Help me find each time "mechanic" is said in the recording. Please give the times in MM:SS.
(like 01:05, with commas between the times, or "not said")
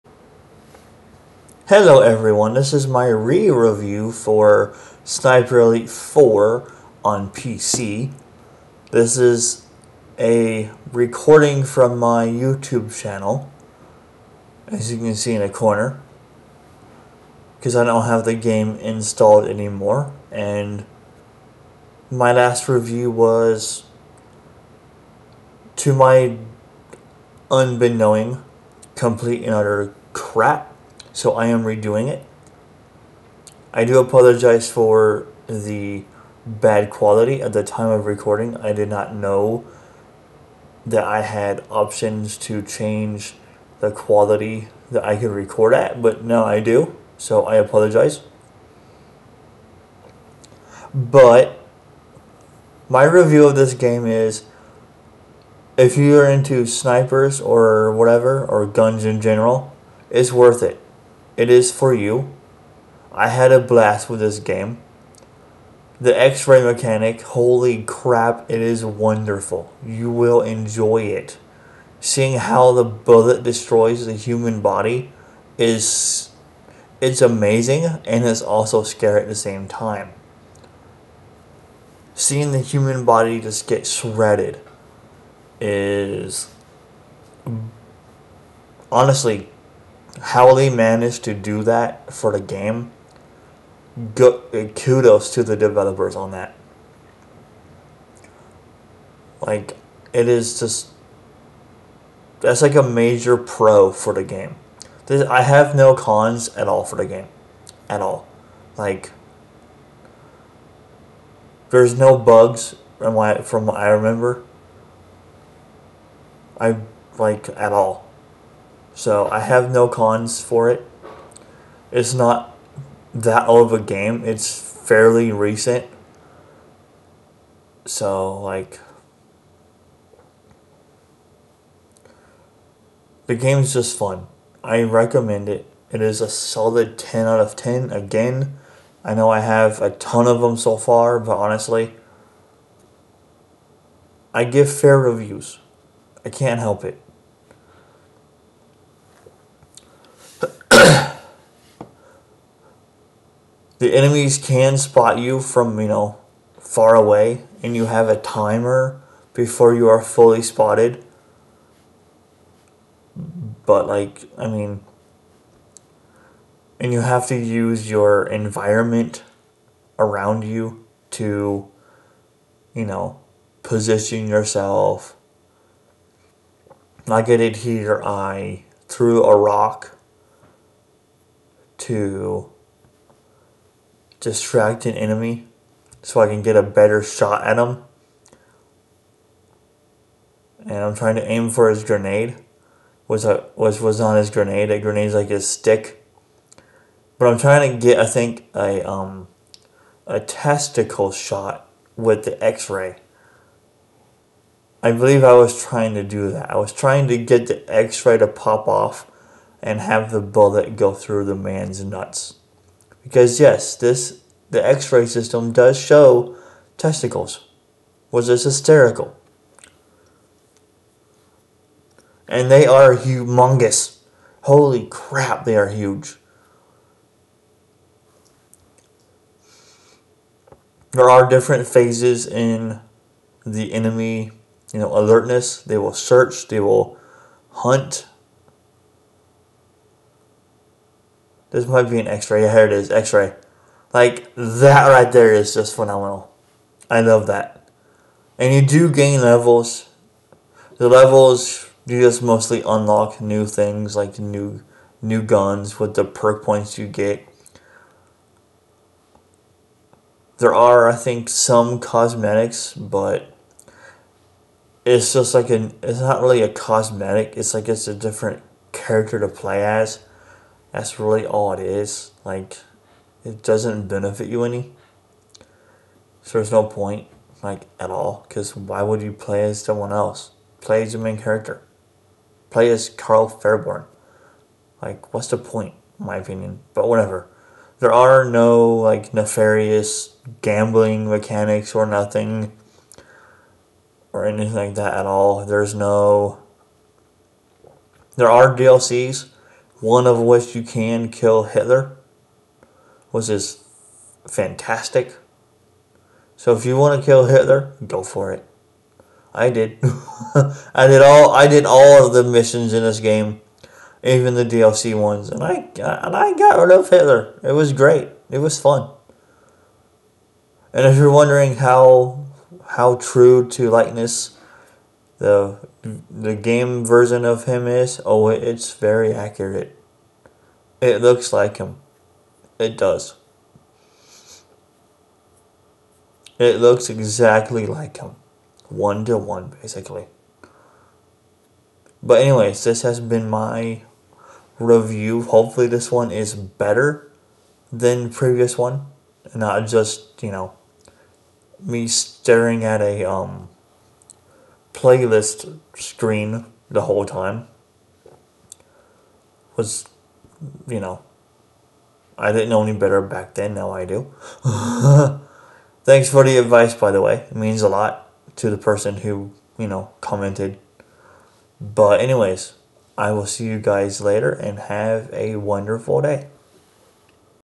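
01:06, 04:51.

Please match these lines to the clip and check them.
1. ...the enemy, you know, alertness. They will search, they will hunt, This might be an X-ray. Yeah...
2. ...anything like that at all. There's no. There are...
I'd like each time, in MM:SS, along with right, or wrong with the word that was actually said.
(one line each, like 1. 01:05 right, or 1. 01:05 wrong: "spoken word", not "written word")
1. 03:53 right
2. 04:54 right.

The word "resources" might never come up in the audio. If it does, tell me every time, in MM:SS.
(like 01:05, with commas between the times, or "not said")
not said.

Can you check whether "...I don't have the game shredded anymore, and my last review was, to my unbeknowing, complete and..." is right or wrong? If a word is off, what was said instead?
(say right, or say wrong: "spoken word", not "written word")
wrong: "installed", not "shredded".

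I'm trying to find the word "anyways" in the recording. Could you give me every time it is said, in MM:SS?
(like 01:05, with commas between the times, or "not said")
05:42, 06:12.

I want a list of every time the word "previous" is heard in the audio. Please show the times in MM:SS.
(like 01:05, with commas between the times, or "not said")
05:48.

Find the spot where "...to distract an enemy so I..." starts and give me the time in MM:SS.
03:01.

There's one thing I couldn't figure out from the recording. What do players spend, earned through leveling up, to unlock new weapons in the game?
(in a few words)
perk points.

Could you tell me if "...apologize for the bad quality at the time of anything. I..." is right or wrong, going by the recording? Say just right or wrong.
wrong.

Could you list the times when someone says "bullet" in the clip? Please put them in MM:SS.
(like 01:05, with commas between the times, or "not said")
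01:12, 03:30.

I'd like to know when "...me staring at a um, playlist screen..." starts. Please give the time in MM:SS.
05:51.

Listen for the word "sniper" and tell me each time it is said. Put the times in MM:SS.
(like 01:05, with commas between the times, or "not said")
00:05, 00:56.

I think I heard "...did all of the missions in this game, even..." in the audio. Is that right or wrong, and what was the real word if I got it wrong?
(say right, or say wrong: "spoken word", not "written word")
right.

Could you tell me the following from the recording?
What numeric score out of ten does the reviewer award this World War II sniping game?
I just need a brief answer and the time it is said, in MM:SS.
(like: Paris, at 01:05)
10 out of 10, at 02:16.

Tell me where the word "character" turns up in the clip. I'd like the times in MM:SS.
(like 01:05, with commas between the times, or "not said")
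04:28, 04:41.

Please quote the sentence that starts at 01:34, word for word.
Go, eh, kudos to the developers on that.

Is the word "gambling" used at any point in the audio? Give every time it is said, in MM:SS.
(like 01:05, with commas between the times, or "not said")
04:50.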